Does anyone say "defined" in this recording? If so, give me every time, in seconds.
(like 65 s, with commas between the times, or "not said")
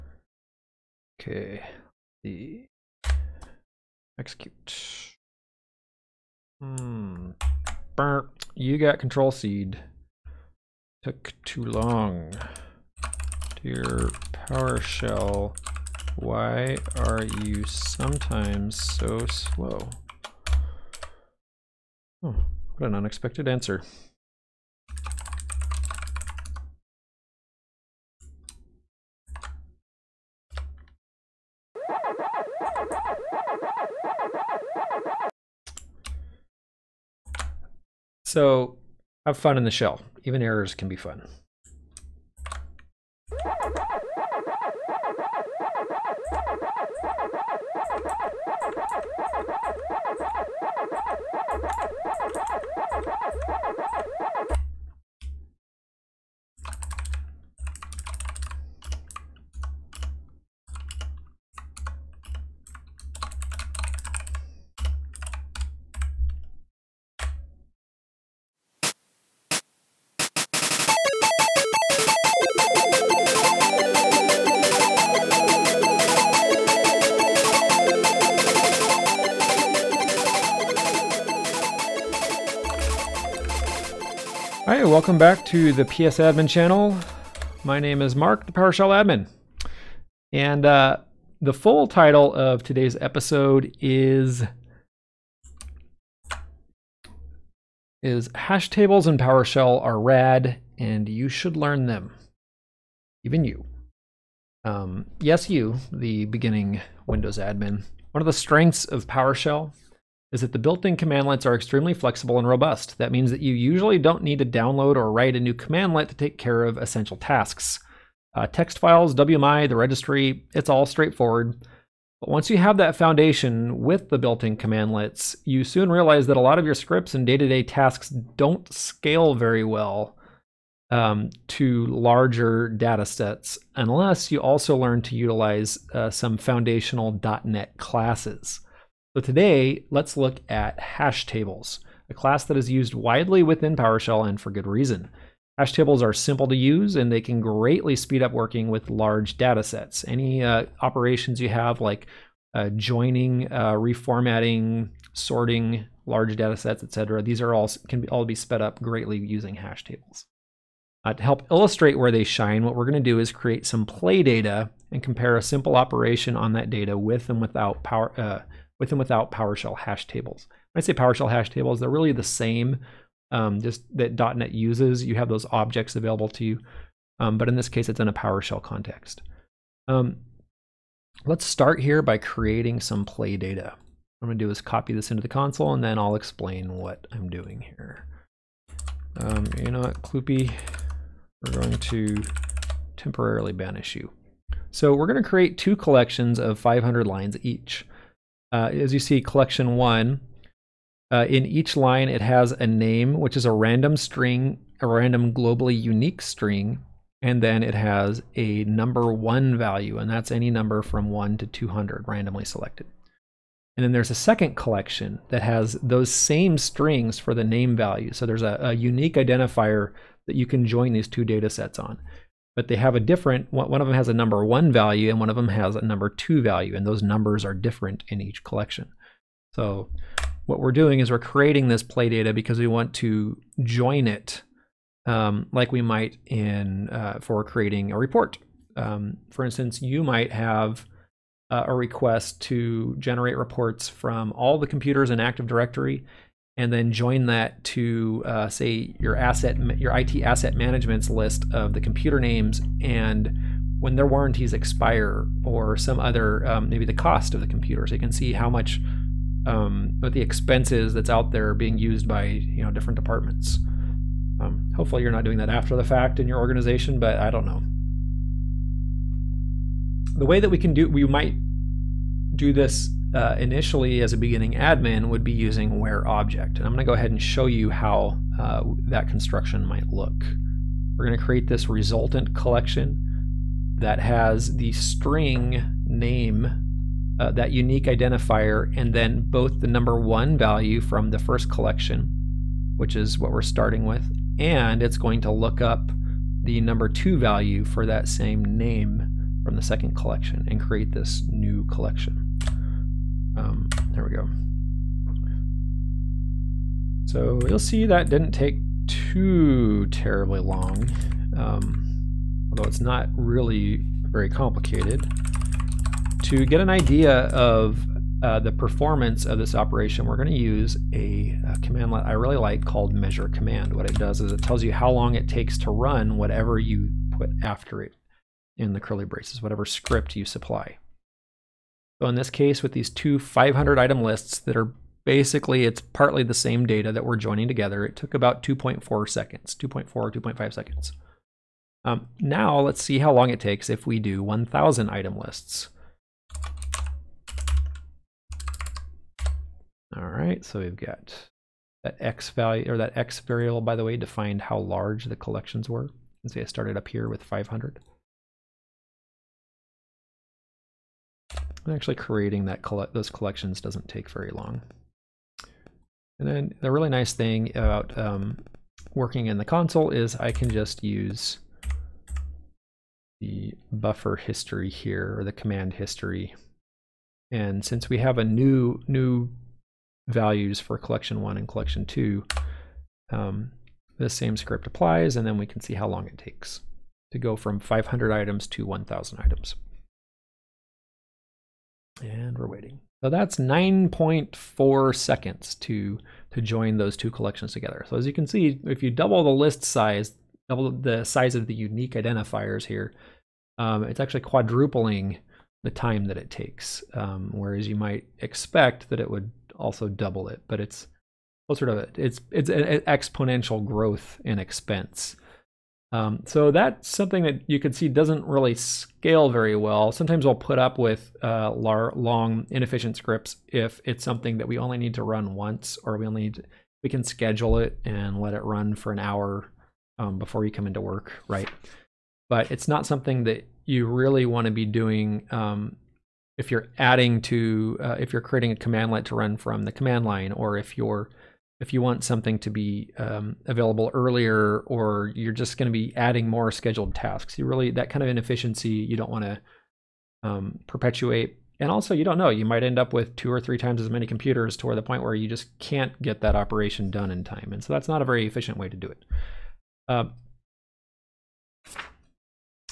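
353 s.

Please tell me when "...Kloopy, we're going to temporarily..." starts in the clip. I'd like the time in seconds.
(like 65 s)
190 s.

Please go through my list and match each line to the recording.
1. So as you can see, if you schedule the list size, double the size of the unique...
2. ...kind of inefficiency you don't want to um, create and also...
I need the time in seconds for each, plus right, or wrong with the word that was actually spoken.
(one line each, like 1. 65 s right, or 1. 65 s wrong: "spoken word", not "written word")
1. 397 s wrong: "double", not "schedule"
2. 447 s wrong: "perpetuate", not "create".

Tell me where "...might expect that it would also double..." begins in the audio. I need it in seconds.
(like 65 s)
407 s.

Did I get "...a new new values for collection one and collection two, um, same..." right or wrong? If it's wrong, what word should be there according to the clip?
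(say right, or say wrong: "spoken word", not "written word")
right.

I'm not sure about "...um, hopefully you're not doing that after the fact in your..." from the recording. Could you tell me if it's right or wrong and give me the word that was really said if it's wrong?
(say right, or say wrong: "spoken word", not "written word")
right.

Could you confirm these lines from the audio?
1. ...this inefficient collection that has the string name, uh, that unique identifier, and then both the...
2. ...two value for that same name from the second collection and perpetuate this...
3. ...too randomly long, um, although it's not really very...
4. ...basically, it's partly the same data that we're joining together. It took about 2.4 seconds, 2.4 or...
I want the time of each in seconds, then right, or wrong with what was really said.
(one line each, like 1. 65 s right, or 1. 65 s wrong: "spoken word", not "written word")
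1. 281 s wrong: "resultant", not "inefficient"
2. 296 s wrong: "create", not "perpetuate"
3. 308 s wrong: "terribly", not "randomly"
4. 335 s right.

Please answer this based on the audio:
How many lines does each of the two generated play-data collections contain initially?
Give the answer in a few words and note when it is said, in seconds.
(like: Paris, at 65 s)
500, at 196 s.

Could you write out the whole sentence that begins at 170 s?
When I say PowerShell hash tables, they're really the same um, just that .NET uses.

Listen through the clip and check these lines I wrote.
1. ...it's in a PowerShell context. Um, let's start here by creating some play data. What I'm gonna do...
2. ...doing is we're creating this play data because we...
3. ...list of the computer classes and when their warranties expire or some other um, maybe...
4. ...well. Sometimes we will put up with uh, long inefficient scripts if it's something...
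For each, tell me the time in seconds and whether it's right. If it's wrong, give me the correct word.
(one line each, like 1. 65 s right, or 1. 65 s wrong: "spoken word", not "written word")
1. 177 s right
2. 230 s right
3. 251 s wrong: "names", not "classes"
4. 419 s right.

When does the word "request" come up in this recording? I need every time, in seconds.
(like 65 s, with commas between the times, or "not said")
241 s.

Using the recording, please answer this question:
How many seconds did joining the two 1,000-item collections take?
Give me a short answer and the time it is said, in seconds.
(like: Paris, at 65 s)
9.4, at 393 s.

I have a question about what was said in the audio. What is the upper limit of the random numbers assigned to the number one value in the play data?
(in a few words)
200.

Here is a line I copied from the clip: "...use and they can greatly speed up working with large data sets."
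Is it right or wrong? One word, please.
right.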